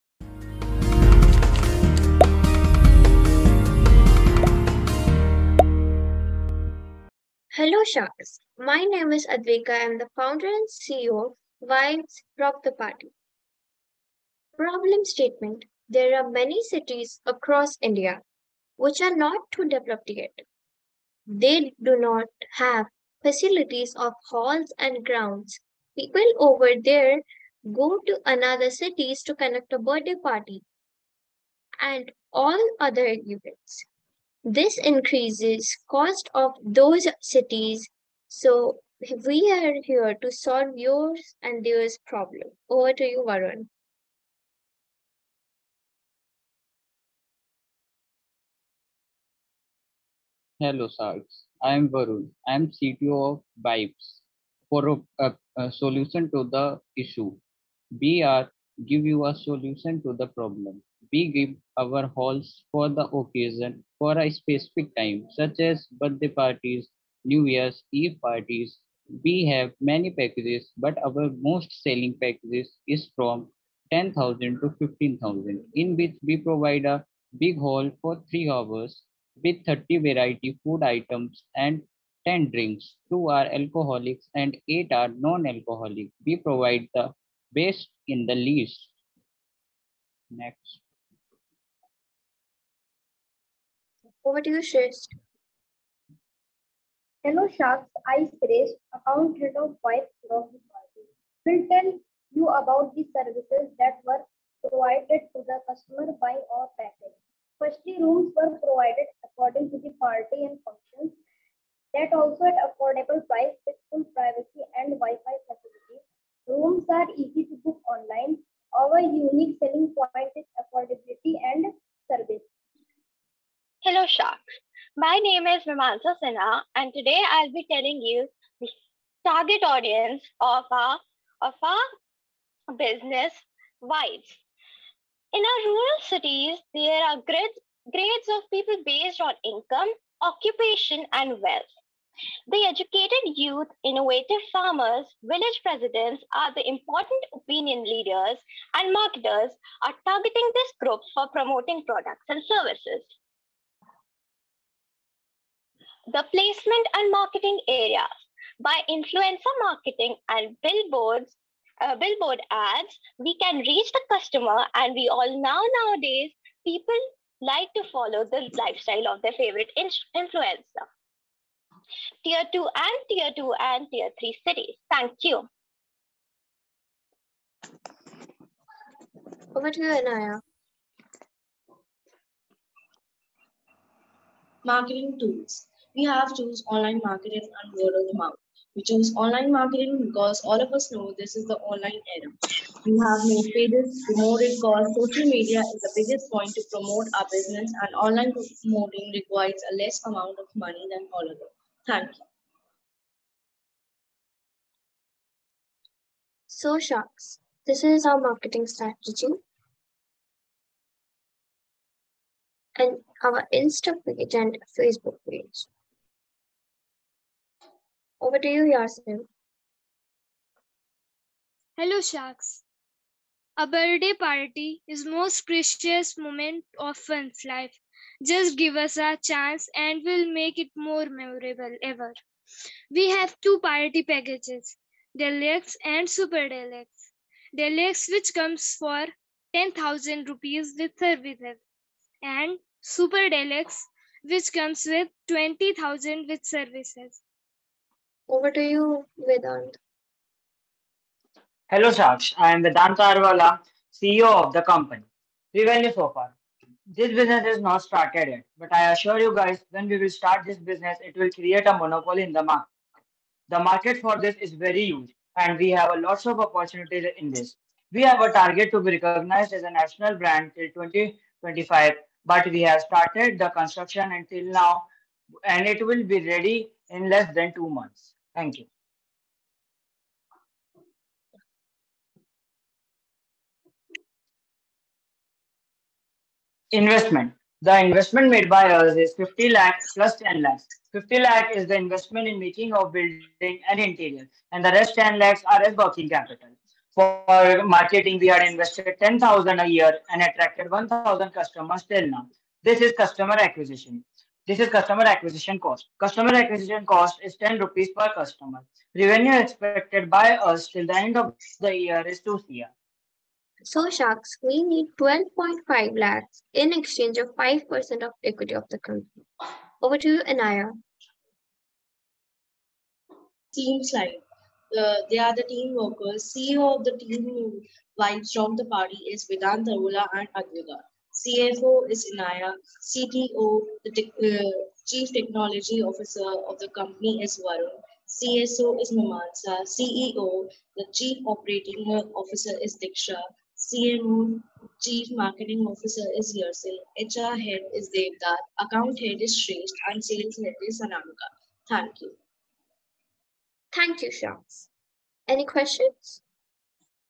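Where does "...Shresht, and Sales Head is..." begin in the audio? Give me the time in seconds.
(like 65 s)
349 s.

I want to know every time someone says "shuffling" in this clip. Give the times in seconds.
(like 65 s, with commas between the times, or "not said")
not said.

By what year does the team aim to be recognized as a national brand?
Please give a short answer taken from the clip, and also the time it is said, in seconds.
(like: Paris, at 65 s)
2025, at 270 s.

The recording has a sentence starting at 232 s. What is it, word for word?
We have two party packages, Deluxe and Super Deluxe.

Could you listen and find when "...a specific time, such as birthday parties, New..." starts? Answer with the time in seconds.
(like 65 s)
64 s.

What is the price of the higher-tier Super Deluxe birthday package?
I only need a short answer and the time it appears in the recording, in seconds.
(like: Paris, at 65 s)
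20,000 rupees, at 245 s.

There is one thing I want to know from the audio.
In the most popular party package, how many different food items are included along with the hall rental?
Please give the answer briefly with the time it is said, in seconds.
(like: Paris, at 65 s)
30, at 79 s.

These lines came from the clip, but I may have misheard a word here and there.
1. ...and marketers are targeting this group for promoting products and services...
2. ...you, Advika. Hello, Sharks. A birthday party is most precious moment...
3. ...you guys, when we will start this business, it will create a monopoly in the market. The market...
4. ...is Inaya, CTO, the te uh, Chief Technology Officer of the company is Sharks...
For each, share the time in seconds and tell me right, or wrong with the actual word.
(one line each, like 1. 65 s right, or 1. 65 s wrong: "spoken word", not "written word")
1. 148 s right
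2. 218 s wrong: "Yasmin", not "Advika"
3. 259 s right
4. 331 s wrong: "Varun", not "Sharks".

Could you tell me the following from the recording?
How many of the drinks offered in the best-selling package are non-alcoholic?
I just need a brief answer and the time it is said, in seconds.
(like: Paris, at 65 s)
8, at 84 s.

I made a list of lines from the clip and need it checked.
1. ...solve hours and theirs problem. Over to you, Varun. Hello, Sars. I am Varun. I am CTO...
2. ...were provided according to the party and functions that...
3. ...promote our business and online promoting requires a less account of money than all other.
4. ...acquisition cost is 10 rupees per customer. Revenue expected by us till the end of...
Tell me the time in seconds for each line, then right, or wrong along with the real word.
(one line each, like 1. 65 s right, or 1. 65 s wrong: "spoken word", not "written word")
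1. 40 s wrong: "yours", not "hours"
2. 108 s right
3. 196 s wrong: "amount", not "account"
4. 306 s right.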